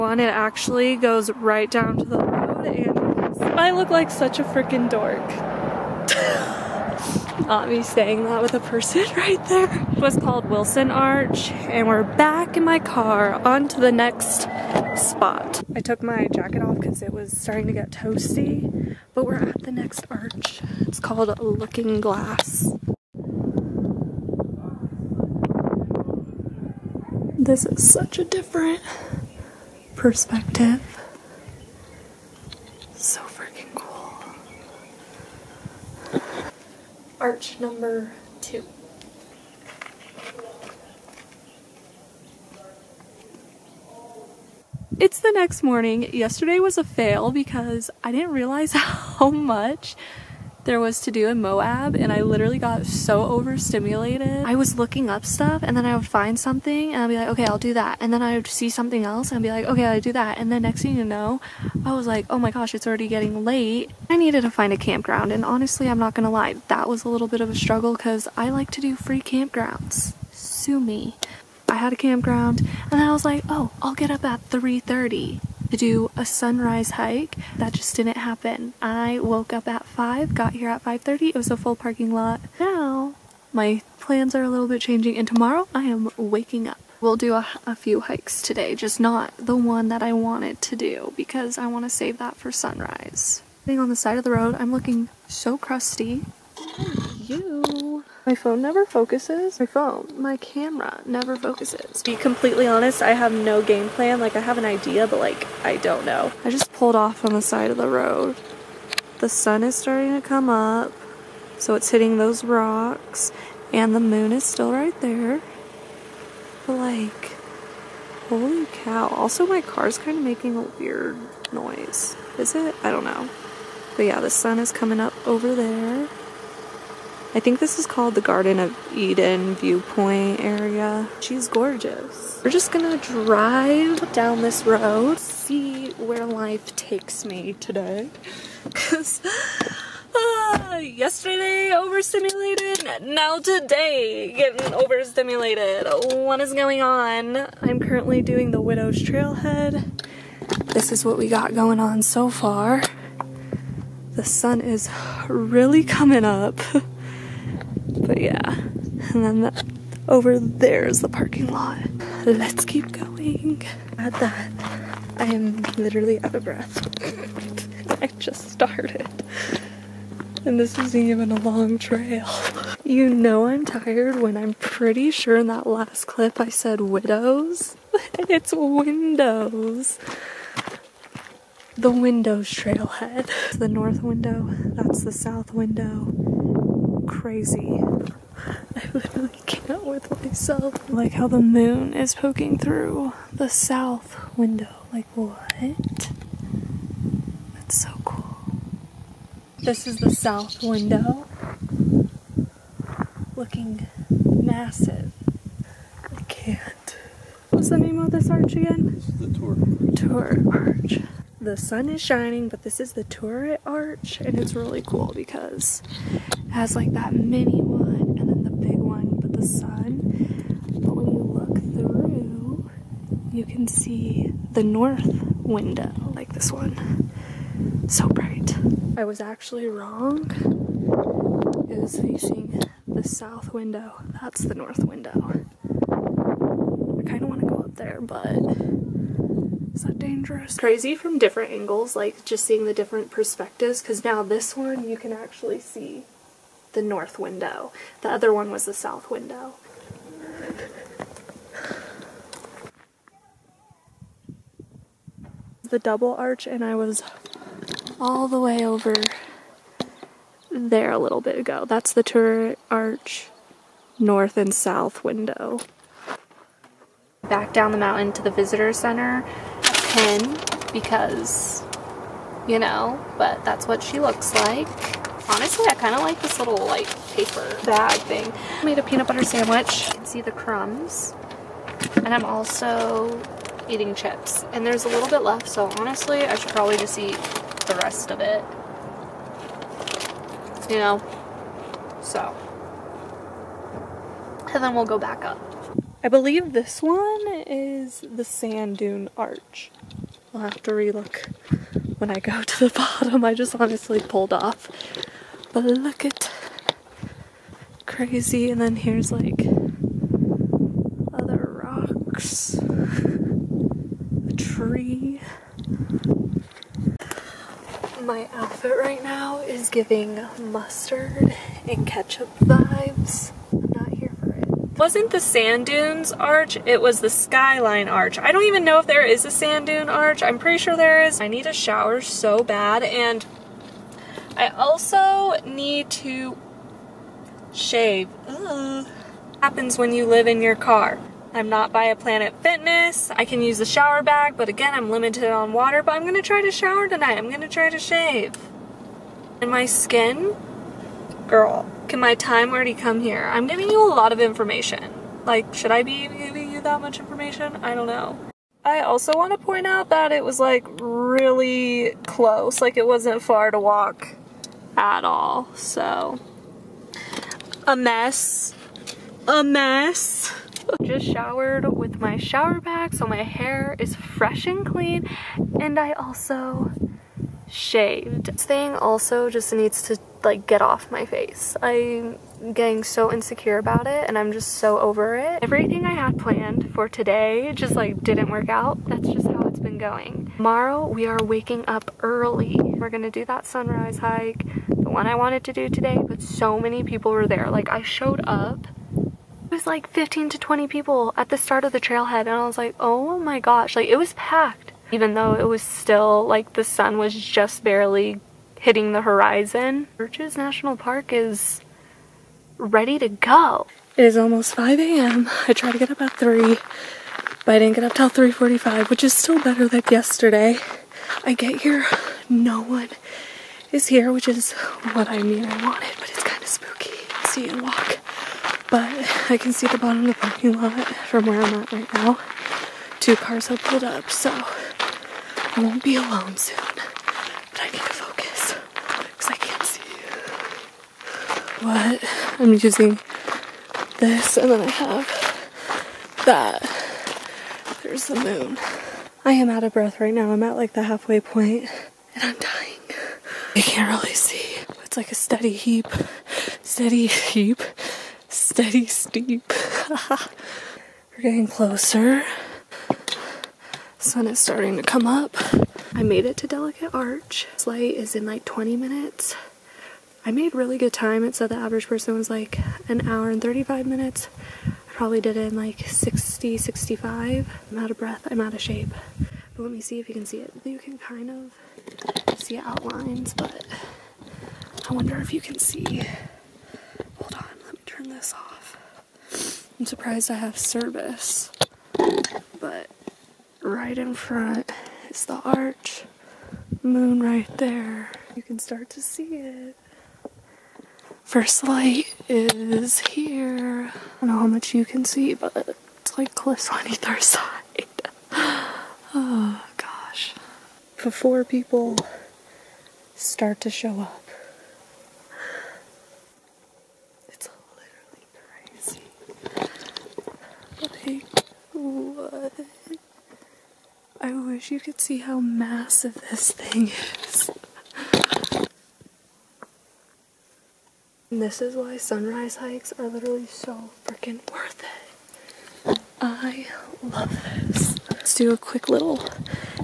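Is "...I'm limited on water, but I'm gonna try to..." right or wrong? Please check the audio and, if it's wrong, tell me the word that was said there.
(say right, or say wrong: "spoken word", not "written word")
right.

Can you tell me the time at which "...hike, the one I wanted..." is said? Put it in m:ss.
6:33.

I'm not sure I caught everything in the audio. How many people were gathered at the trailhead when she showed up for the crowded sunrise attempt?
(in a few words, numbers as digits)
15 to 20.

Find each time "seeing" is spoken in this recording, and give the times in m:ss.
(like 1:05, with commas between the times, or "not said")
4:02.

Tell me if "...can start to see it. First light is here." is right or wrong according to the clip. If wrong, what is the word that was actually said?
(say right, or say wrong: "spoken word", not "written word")
right.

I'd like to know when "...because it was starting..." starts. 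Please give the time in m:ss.
0:16.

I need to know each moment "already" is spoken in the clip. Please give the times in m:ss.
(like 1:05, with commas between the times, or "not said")
1:02, 5:52.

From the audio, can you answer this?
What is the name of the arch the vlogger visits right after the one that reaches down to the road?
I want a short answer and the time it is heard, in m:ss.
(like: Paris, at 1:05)
Looking Glass, at 0:21.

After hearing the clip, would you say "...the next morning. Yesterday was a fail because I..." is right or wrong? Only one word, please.
right.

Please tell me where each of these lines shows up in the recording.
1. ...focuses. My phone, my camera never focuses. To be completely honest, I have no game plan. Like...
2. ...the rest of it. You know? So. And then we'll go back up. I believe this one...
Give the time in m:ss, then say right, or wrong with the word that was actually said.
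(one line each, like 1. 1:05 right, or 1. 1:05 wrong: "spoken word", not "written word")
1. 1:38 right
2. 4:47 right.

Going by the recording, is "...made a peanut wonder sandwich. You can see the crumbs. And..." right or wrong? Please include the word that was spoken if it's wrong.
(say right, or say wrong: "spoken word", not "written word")
wrong: "butter", not "wonder".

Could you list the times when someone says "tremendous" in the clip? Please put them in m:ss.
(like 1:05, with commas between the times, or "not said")
not said.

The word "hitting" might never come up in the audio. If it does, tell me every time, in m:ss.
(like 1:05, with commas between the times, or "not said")
1:51, 6:48.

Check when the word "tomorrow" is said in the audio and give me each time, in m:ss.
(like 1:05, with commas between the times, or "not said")
1:25, 6:30.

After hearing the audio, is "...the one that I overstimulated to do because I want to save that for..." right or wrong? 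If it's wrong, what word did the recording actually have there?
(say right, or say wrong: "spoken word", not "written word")
wrong: "wanted", not "overstimulated".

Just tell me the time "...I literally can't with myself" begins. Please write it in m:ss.
3:08.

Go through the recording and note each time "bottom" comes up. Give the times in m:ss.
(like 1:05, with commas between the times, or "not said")
5:02, 7:09.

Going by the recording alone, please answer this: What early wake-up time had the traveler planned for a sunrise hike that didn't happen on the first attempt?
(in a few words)
3:30.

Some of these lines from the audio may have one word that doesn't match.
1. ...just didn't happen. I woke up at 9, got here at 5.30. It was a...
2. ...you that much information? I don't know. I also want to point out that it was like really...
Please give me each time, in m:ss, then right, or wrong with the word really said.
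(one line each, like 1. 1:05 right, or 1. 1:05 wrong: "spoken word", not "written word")
1. 1:17 wrong: "5", not "9"
2. 5:56 right.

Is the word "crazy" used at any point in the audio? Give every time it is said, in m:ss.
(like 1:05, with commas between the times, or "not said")
3:07, 4:00, 5:07, 8:39.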